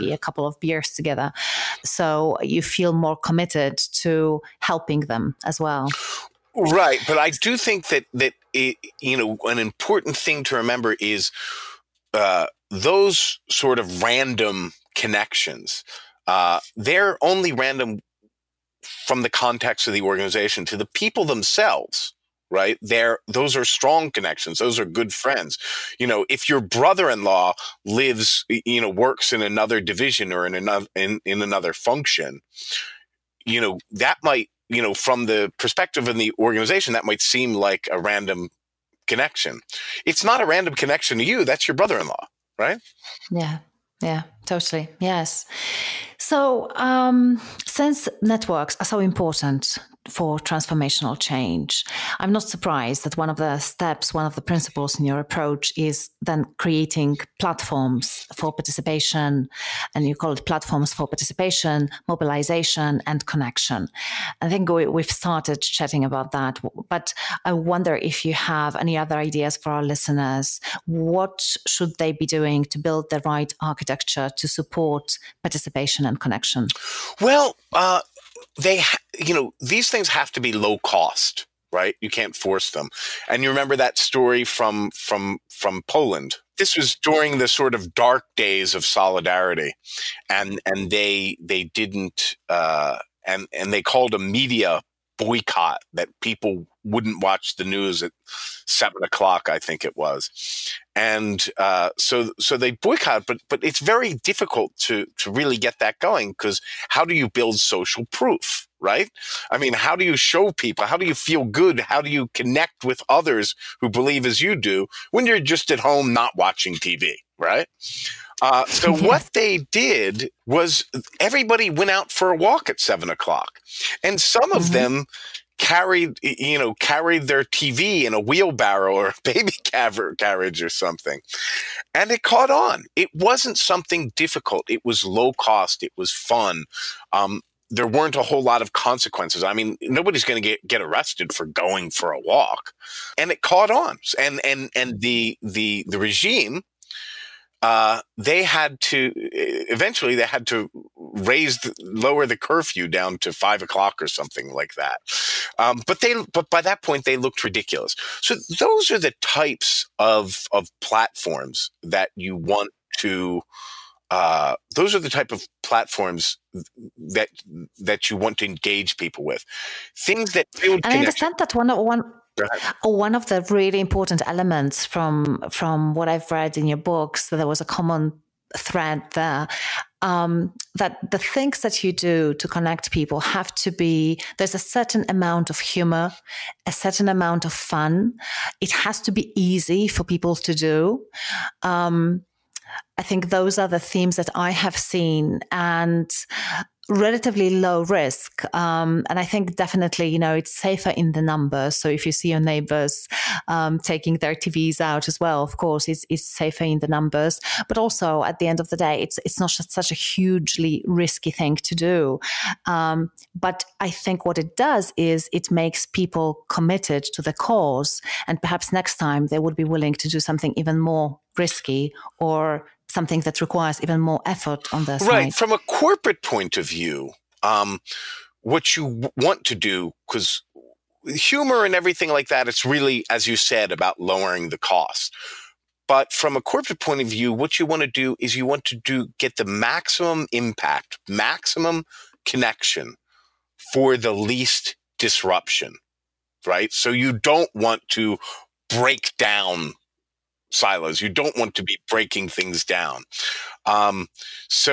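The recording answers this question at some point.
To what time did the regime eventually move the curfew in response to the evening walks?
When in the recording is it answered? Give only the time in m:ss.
2:33.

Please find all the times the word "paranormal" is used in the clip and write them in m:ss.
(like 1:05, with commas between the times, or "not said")
not said.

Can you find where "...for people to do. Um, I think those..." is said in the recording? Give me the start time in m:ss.
3:09.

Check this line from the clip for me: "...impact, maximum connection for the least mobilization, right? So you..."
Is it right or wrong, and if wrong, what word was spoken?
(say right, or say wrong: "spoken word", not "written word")
wrong: "disruption", not "mobilization".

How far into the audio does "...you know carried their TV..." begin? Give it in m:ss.
2:06.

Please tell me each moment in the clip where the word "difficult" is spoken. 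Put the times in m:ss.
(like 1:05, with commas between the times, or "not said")
1:44, 2:14.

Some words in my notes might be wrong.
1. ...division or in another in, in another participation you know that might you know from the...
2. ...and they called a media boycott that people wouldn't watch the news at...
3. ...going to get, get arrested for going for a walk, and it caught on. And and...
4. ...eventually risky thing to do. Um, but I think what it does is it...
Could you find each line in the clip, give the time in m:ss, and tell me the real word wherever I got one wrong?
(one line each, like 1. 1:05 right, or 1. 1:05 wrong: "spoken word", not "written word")
1. 0:29 wrong: "function", not "participation"
2. 1:33 right
3. 2:20 right
4. 3:29 wrong: "hugely", not "eventually".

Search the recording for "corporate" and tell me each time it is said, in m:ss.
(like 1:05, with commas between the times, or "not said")
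3:45, 3:56.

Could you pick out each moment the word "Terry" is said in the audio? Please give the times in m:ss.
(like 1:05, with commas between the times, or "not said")
not said.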